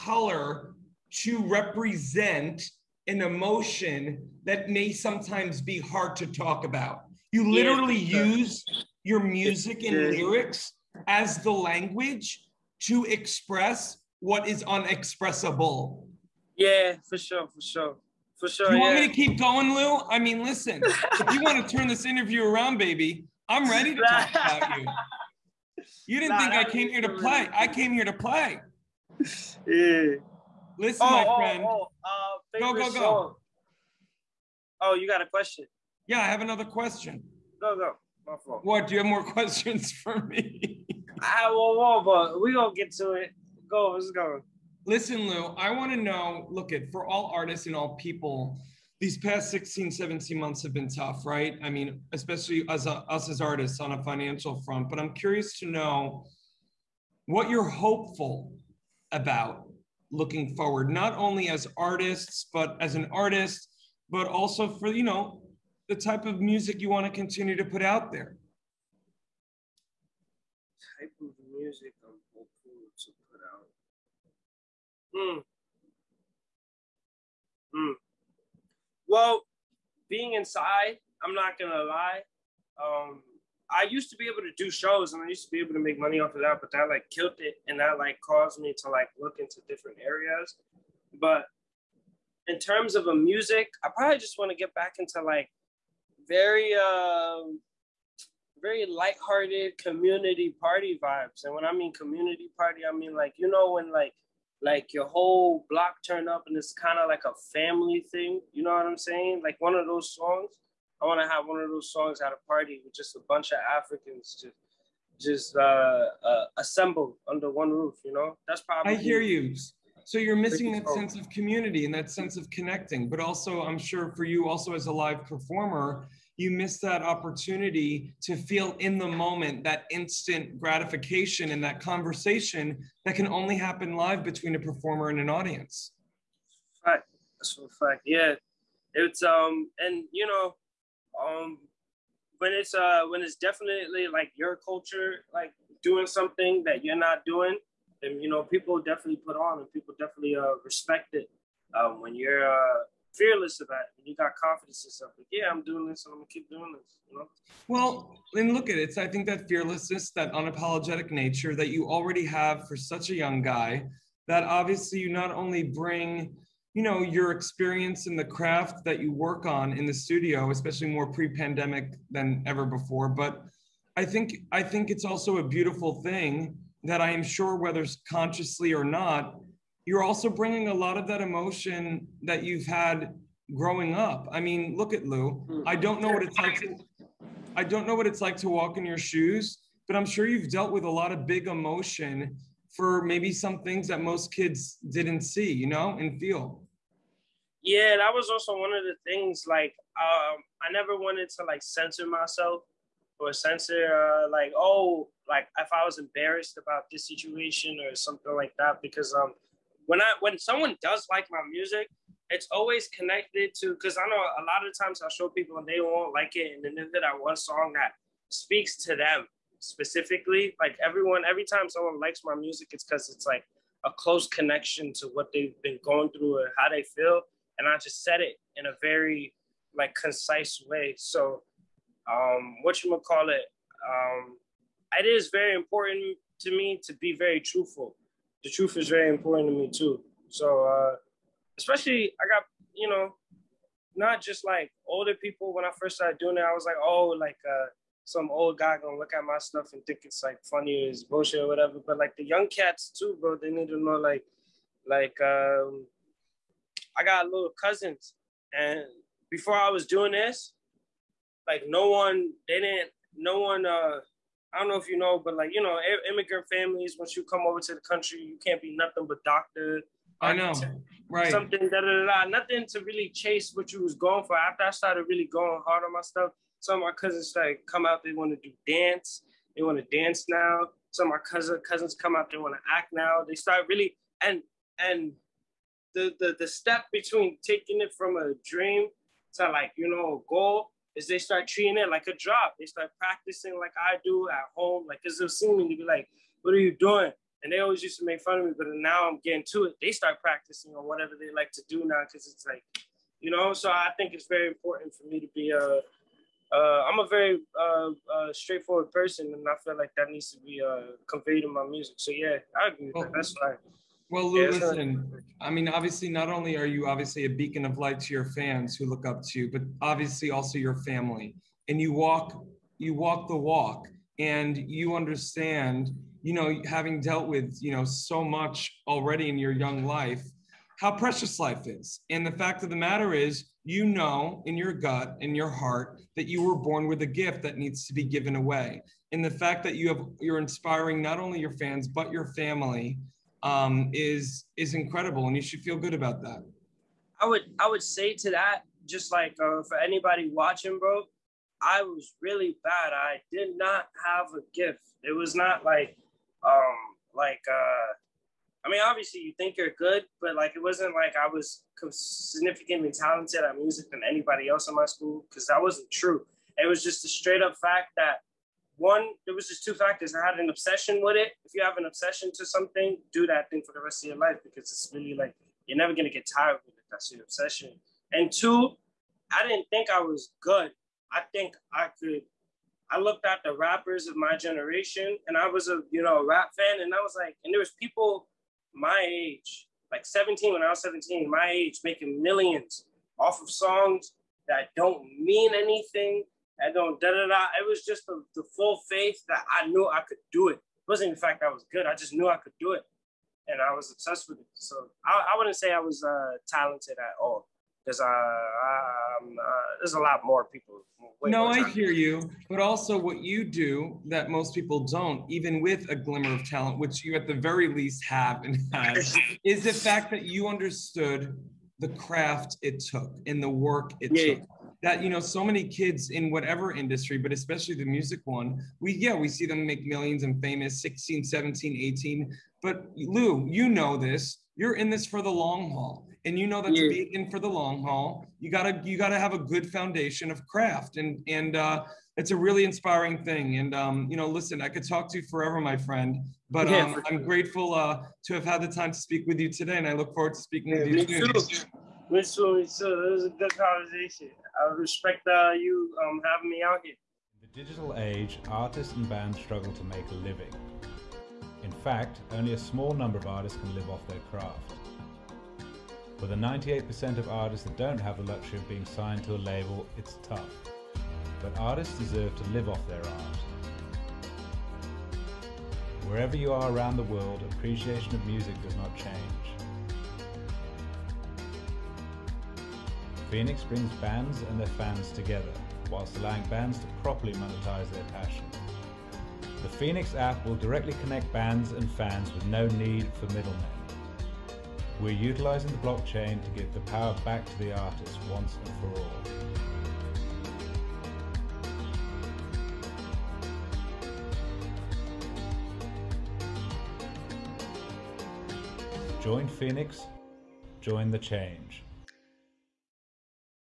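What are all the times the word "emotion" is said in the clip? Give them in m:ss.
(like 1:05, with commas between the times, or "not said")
0:03, 3:01, 3:11.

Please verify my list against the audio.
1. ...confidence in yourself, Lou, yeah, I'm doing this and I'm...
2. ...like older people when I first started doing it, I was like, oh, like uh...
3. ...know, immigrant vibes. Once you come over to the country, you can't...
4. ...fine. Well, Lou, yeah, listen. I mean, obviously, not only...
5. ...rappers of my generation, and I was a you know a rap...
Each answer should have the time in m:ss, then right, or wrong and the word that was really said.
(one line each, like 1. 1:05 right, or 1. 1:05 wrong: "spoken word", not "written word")
1. 2:34 wrong: "Like", not "Lou"
2. 4:04 right
3. 4:25 wrong: "families", not "vibes"
4. 5:13 right
5. 6:23 right.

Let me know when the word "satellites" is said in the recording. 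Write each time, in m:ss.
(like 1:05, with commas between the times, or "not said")
not said.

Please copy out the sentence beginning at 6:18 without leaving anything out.
And two, I didn't think I was good.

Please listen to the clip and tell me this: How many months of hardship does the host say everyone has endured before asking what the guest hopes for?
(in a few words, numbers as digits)
16, 17 months.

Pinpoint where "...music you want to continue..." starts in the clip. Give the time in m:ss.
1:06.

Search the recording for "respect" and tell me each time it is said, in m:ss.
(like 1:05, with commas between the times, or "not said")
2:30, 7:34.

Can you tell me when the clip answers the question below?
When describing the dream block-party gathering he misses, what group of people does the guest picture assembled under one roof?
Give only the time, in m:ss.
1:53.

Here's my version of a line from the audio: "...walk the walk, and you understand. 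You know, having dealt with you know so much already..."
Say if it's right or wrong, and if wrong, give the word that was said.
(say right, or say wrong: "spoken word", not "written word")
right.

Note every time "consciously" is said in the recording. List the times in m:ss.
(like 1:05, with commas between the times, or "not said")
2:58.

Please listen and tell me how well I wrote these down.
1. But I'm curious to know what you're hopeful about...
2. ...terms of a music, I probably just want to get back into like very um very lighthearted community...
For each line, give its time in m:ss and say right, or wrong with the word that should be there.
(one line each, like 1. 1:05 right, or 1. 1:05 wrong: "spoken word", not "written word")
1. 0:54 right
2. 1:32 right.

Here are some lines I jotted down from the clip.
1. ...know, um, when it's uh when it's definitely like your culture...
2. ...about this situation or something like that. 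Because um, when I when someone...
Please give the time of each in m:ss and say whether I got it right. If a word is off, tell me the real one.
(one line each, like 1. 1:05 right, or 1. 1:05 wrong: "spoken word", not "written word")
1. 2:20 right
2. 3:26 right.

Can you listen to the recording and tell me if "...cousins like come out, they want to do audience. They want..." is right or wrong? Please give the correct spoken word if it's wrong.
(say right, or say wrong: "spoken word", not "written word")
wrong: "dance", not "audience".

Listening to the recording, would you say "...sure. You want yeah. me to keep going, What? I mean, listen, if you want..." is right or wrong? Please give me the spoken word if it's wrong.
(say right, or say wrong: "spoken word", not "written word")
wrong: "Lou", not "What".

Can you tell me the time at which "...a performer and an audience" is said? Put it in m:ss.
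2:14.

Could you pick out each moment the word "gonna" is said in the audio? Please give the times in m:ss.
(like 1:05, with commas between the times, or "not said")
0:42, 1:21, 2:36, 4:08, 6:15.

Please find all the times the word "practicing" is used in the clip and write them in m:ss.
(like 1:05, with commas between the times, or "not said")
4:52, 5:00.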